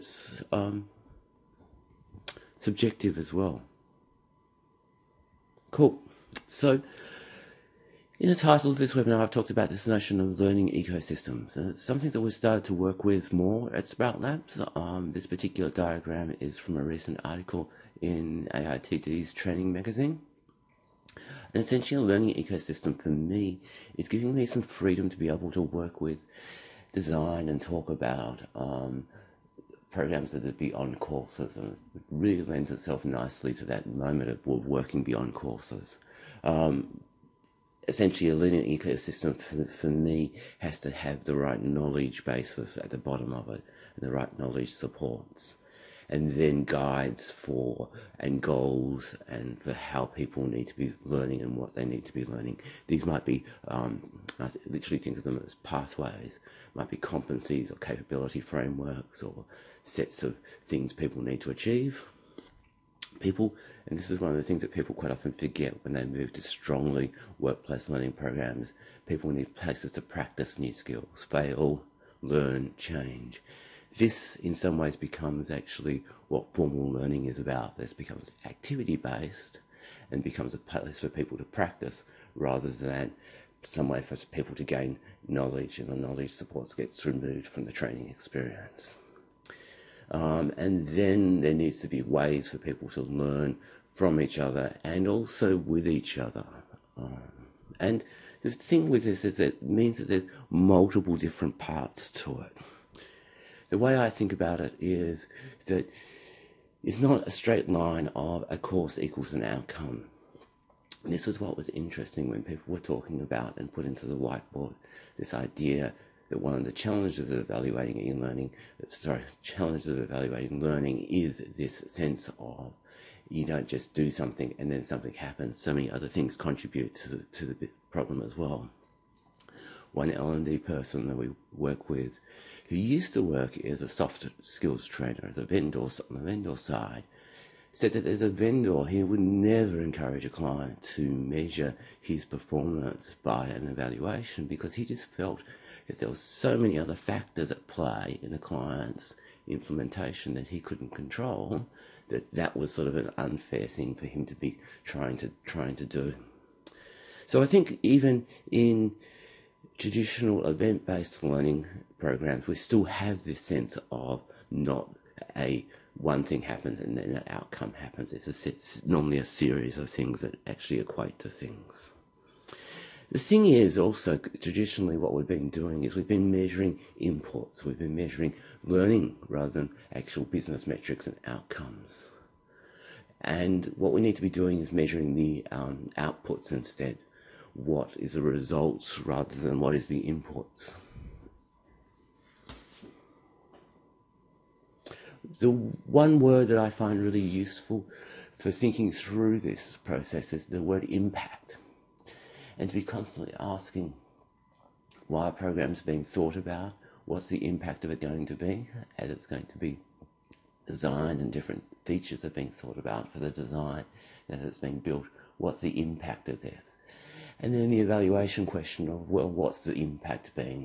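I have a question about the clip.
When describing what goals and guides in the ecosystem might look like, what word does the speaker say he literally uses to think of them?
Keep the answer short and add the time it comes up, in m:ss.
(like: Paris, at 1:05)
pathways, at 0:55.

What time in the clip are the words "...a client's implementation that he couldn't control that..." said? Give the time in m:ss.
2:28.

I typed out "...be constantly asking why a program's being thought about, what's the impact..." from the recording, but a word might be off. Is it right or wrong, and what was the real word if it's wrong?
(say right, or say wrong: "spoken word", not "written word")
right.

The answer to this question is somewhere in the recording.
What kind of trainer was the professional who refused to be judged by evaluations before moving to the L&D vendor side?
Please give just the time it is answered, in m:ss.
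2:13.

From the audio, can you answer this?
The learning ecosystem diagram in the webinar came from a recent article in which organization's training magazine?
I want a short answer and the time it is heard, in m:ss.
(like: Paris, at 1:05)
AITD, at 0:18.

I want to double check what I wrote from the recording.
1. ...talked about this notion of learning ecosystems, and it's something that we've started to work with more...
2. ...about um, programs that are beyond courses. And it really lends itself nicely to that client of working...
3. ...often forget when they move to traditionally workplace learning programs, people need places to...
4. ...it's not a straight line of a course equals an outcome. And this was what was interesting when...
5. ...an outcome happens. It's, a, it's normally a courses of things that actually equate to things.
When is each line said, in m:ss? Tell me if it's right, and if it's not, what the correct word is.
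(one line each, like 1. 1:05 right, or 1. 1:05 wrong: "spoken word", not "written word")
1. 0:09 right
2. 0:27 wrong: "moment", not "client"
3. 1:05 wrong: "strongly", not "traditionally"
4. 1:46 right
5. 2:47 wrong: "series", not "courses".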